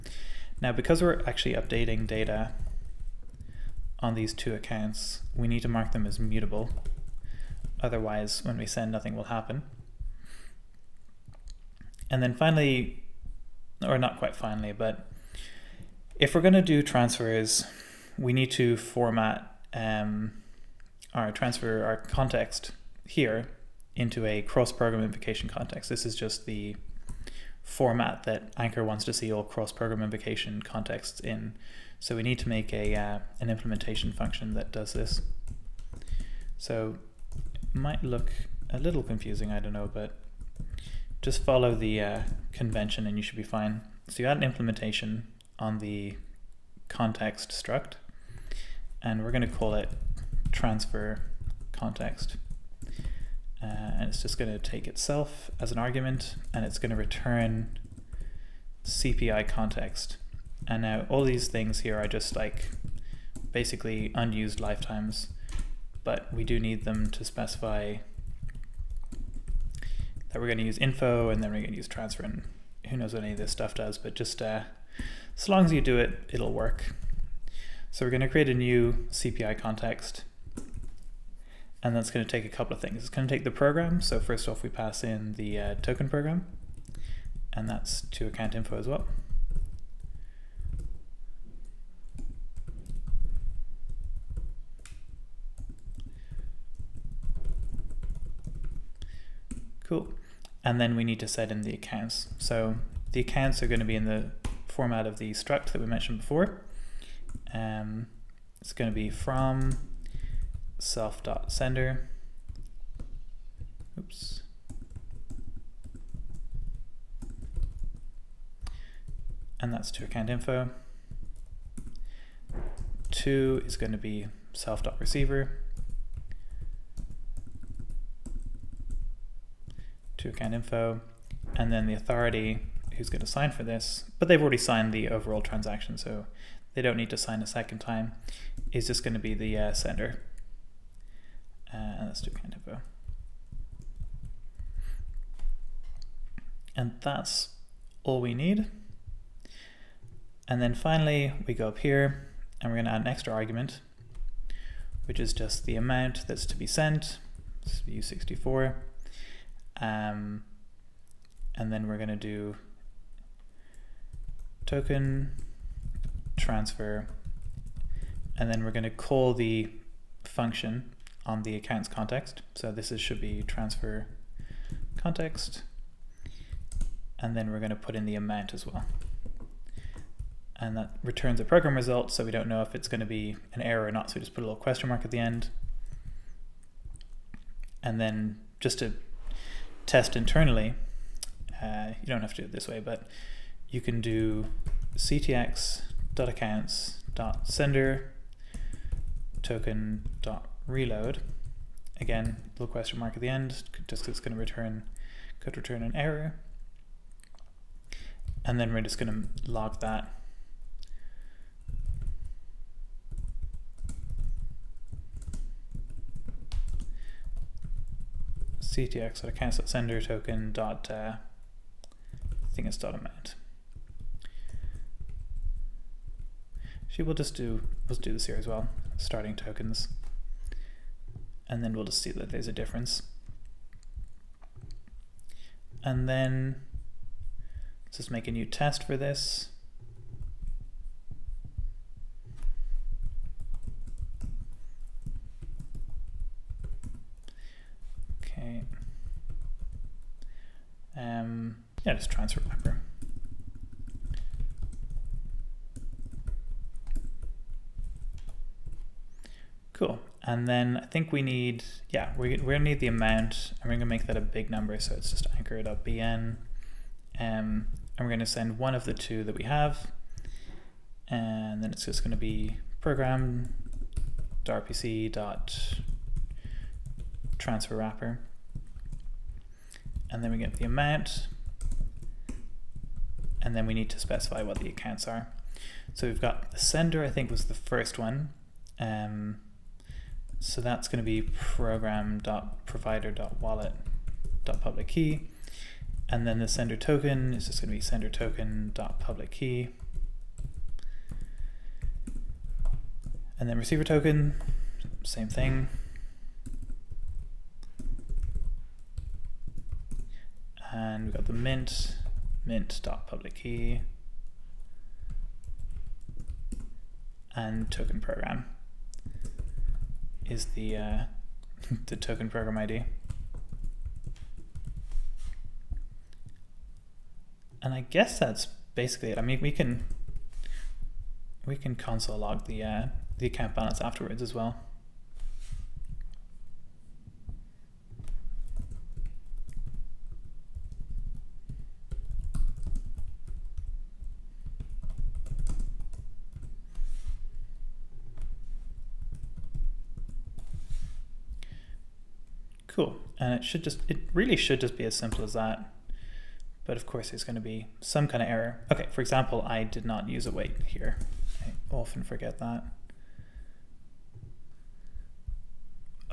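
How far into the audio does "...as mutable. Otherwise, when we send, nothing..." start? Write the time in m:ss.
0:06.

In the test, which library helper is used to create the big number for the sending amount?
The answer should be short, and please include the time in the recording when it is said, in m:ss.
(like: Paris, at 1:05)
anchor.bn, at 4:25.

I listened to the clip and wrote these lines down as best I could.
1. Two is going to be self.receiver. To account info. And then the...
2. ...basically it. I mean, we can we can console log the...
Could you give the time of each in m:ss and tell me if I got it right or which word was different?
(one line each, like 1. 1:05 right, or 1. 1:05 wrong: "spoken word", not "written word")
1. 2:03 right
2. 5:28 right.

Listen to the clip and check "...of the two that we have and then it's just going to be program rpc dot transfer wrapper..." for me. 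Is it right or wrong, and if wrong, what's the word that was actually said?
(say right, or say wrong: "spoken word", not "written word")
right.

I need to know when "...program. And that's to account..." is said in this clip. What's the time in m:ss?
1:26.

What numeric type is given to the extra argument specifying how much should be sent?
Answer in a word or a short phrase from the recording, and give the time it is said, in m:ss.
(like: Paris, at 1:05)
U64, at 2:38.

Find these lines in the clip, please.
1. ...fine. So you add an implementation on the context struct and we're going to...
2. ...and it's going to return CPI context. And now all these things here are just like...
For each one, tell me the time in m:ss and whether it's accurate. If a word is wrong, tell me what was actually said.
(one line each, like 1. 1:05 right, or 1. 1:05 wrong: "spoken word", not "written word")
1. 0:43 right
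2. 0:56 right.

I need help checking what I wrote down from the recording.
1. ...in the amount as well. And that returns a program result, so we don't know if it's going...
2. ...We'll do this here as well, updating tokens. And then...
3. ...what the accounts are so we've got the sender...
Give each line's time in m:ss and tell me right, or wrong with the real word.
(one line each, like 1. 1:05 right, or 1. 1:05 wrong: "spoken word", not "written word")
1. 2:57 right
2. 3:47 wrong: "starting", not "updating"
3. 4:44 right.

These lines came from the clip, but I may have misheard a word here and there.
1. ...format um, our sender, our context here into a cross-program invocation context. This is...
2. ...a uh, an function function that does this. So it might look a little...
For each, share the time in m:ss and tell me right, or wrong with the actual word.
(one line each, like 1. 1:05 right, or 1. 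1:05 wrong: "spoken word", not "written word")
1. 0:18 wrong: "transfer", not "sender"
2. 0:32 wrong: "implementation", not "function".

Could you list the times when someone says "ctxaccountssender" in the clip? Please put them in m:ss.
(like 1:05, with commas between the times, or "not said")
3:14, 3:38.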